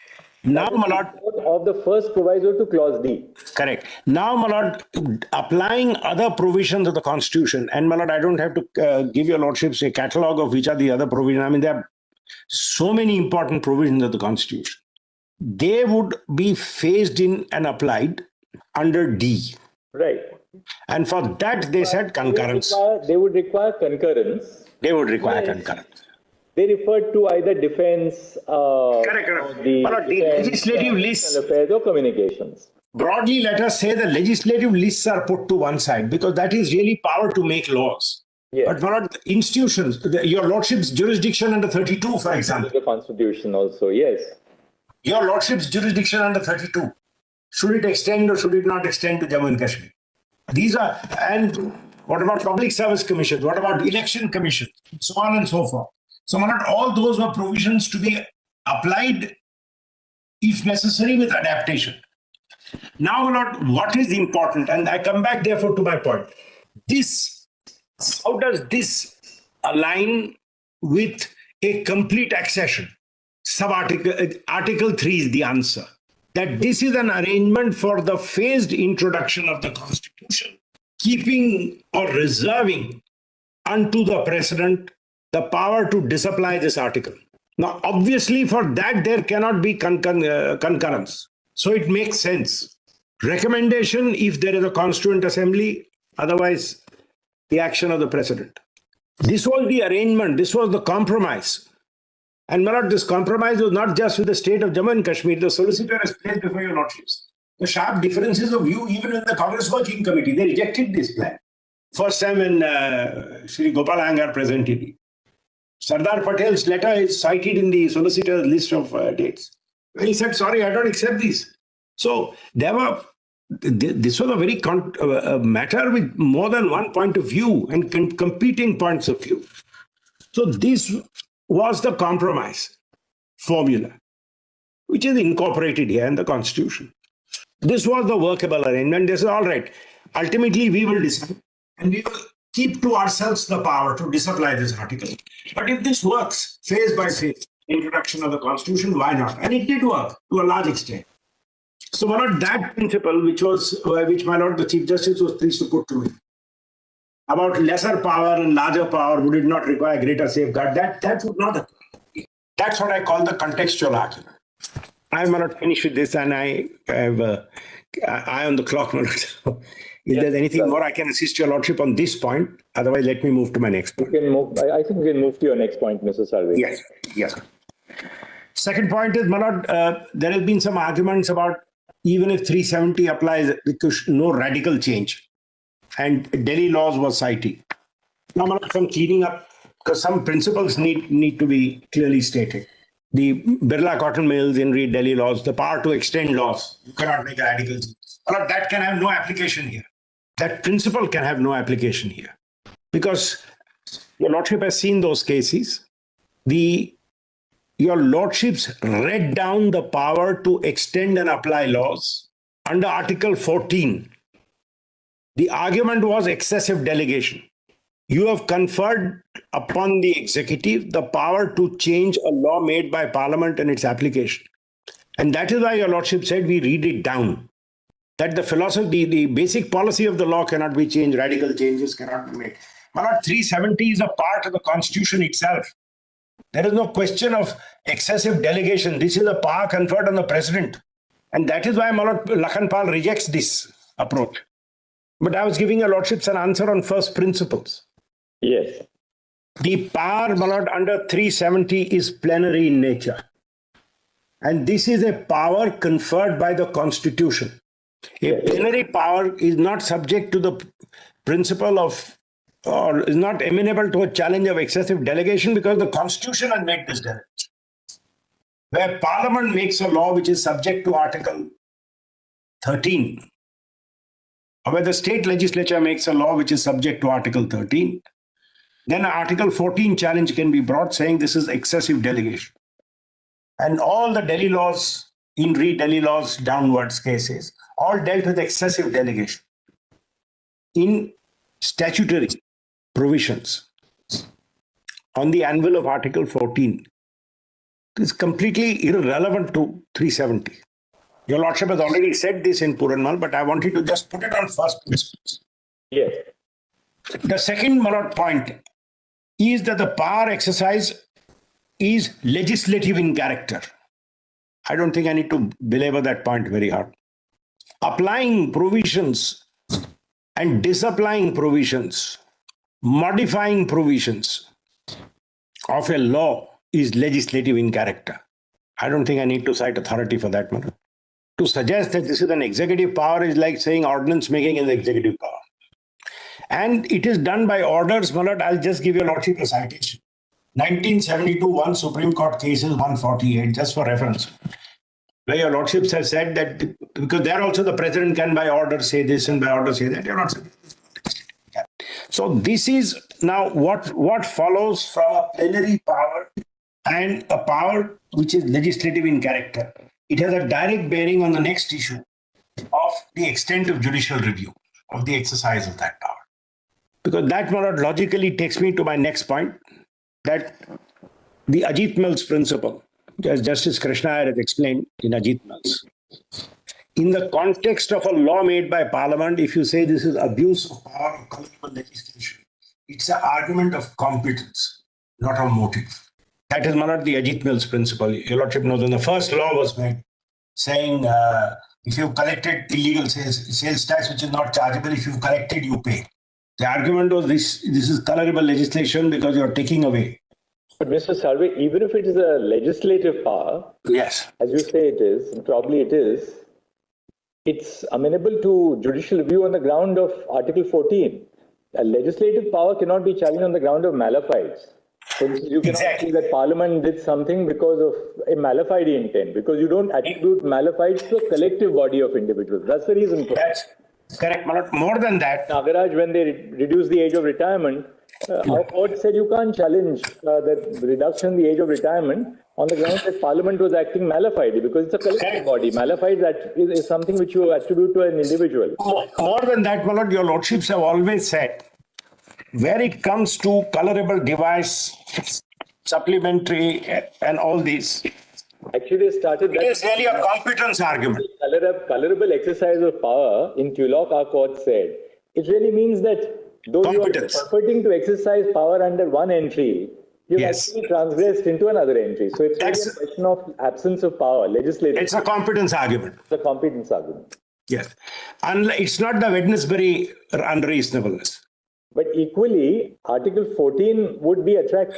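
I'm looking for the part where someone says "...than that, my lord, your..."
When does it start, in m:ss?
7:19.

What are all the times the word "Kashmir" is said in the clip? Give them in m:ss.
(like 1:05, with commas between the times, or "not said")
0:49, 1:45.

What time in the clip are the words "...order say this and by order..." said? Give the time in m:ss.
5:48.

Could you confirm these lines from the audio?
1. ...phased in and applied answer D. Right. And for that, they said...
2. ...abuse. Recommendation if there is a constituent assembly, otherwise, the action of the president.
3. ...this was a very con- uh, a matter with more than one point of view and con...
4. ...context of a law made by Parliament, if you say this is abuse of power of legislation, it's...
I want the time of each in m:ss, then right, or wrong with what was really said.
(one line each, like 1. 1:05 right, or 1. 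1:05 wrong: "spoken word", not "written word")
1. 0:16 wrong: "under", not "answer"
2. 1:32 wrong: "sense", not "abuse"
3. 2:03 right
4. 6:17 right.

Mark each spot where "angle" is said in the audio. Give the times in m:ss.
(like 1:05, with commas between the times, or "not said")
not said.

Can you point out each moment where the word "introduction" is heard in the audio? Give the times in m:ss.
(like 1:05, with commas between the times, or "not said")
1:18, 2:27.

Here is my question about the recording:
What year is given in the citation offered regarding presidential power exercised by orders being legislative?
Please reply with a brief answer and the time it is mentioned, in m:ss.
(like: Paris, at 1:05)
1972, at 5:40.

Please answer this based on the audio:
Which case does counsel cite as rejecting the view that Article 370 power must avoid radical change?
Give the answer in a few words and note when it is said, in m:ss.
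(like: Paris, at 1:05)
Lakhanpal, at 4:02.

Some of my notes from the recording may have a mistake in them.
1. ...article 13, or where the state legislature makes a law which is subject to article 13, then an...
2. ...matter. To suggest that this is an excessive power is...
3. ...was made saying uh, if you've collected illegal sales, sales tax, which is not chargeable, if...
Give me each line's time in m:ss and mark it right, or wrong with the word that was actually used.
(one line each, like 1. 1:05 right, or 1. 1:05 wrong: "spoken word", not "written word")
1. 4:30 right
2. 5:30 wrong: "executive", not "excessive"
3. 6:29 right.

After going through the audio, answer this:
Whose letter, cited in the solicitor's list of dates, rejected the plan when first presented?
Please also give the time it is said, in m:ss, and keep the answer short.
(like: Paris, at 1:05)
Sardar Patel, at 1:55.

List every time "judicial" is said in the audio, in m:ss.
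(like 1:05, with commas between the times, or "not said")
6:03, 6:48.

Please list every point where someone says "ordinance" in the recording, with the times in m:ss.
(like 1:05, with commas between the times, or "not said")
5:33.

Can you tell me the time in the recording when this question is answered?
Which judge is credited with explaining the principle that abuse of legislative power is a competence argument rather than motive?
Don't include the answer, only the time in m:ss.
6:13.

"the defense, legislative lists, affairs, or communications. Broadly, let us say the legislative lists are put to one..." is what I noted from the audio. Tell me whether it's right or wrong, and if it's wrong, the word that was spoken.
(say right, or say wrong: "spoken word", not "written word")
right.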